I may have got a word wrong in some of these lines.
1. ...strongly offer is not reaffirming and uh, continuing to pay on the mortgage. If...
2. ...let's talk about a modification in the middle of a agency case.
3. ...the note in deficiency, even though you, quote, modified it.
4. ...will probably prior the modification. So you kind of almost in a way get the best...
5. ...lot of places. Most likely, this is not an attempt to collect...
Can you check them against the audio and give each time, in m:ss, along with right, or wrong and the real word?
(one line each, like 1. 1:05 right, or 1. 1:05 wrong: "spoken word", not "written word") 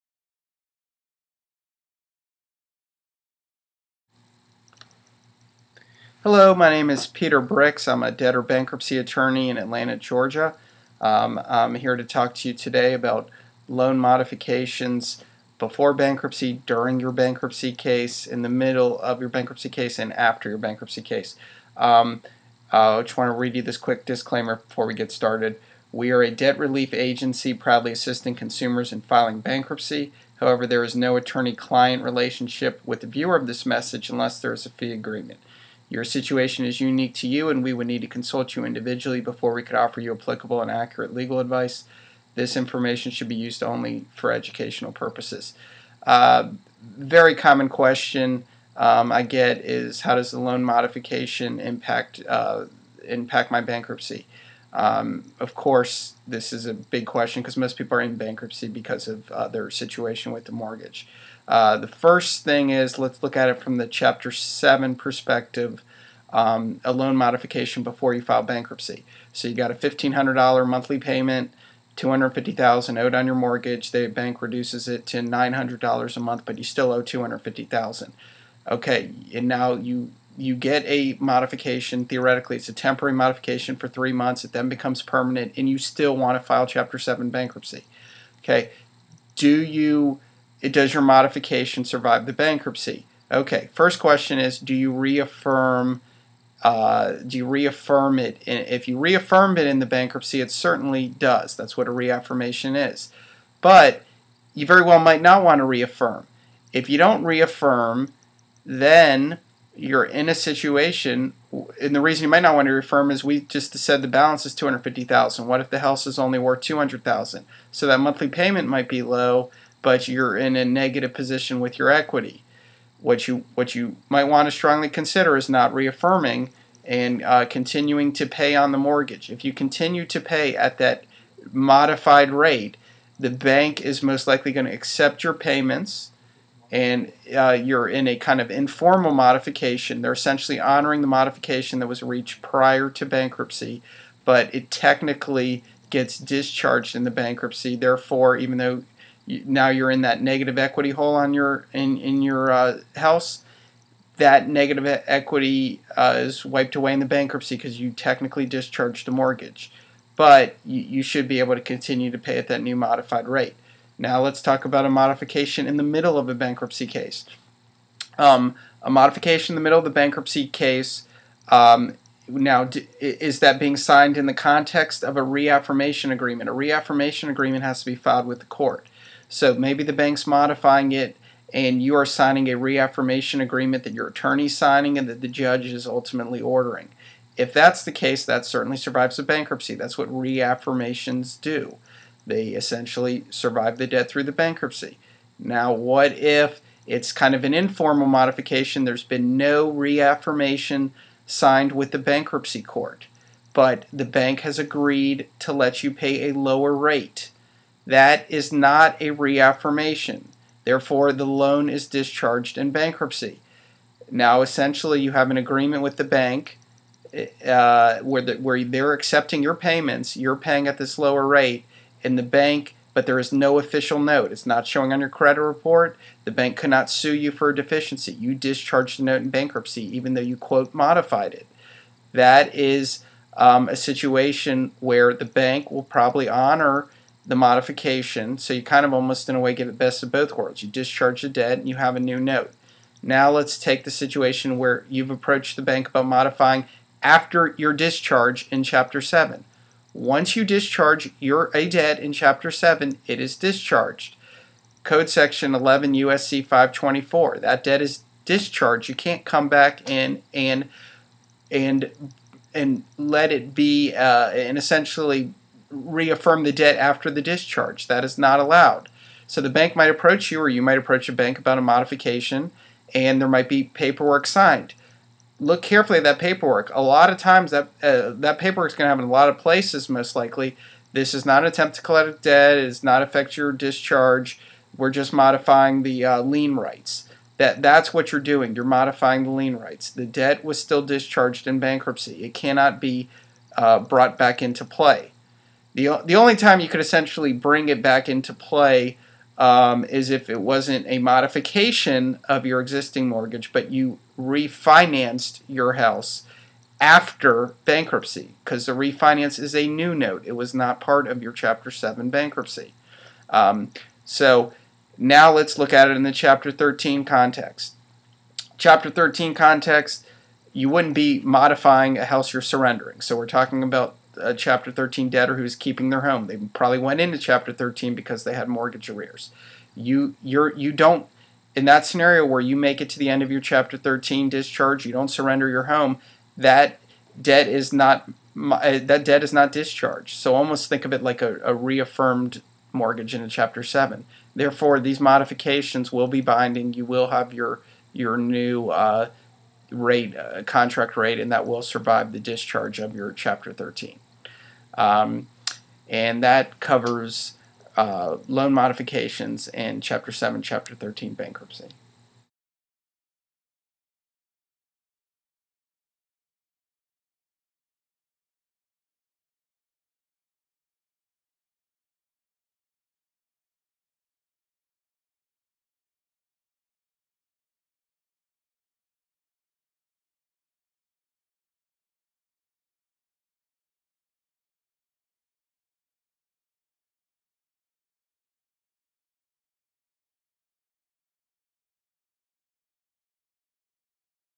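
1. 2:04 wrong: "consider", not "offer"
2. 2:44 wrong: "bankruptcy", not "agency"
3. 3:48 wrong: "bankruptcy", not "deficiency"
4. 3:55 wrong: "honor", not "prior"
5. 4:39 right.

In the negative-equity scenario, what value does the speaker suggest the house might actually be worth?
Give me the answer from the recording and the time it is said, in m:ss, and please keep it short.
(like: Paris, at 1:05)
$200,000, at 1:56.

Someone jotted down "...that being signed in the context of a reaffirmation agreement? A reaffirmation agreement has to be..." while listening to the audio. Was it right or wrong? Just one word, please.
right.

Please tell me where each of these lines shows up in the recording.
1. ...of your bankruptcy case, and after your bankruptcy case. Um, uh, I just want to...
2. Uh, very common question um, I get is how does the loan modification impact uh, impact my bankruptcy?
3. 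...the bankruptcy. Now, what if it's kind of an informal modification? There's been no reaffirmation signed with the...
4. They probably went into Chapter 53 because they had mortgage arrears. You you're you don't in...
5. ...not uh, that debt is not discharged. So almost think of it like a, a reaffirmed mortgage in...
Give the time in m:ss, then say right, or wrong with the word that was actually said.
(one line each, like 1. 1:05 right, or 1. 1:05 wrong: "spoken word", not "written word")
1. 0:18 right
2. 0:46 right
3. 3:14 right
4. 5:26 wrong: "13", not "53"
5. 5:37 right.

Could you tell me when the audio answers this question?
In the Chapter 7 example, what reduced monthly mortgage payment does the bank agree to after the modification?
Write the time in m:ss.
1:15.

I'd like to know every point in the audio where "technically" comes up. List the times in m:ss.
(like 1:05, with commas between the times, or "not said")
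2:24, 2:37.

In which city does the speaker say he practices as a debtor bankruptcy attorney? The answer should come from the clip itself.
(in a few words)
Atlanta, Georgia.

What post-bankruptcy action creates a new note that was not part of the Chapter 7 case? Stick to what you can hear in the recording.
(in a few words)
refinanced.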